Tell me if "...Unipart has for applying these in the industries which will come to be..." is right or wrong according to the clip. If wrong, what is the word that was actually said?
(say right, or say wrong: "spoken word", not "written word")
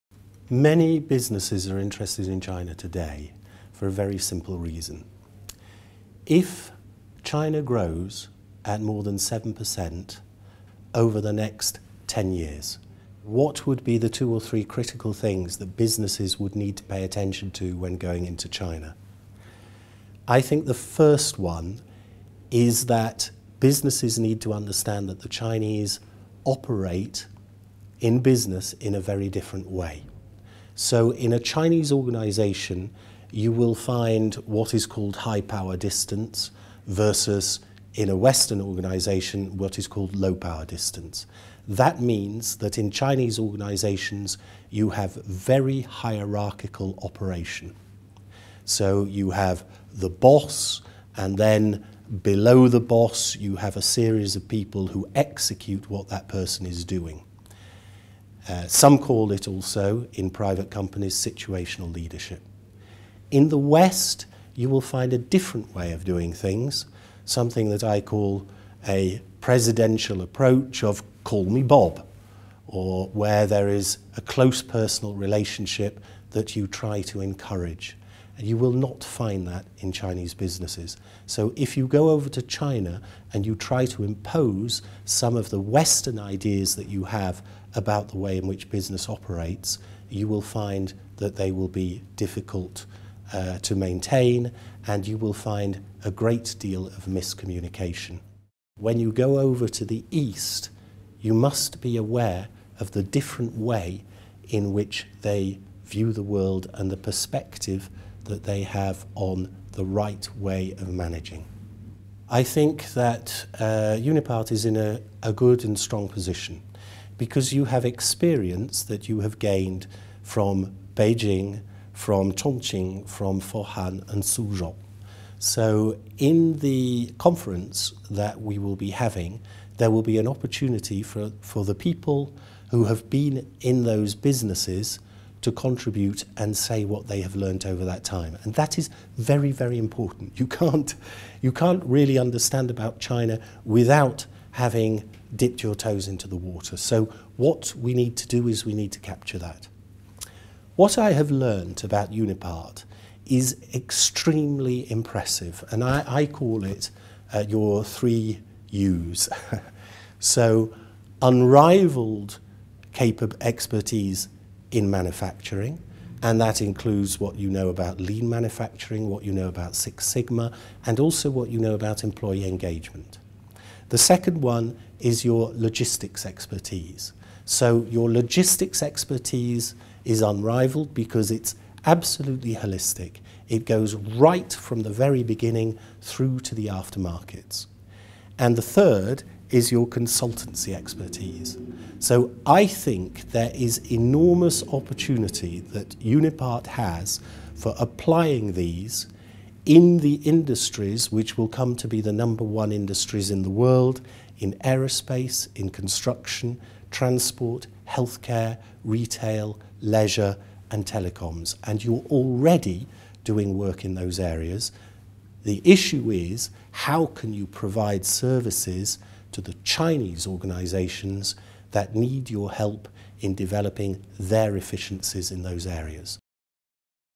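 right.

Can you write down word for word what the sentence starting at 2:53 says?
The second one is your logistics expertise.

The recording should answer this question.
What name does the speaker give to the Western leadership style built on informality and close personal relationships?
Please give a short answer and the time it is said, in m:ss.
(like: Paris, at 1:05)
presidential approach, at 1:09.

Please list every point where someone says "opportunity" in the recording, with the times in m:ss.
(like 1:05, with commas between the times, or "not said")
2:10, 3:14.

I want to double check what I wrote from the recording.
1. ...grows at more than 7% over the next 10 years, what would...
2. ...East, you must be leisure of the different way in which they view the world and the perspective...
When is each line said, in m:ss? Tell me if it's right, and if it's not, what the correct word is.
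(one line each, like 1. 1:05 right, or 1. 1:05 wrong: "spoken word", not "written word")
1. 0:07 right
2. 1:40 wrong: "aware", not "leisure".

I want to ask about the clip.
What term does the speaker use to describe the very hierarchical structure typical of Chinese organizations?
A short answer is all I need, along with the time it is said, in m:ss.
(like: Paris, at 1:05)
high power distance, at 0:35.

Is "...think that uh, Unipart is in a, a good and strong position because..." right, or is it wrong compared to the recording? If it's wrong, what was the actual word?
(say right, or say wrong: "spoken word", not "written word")
right.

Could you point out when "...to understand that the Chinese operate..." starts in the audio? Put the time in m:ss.
0:24.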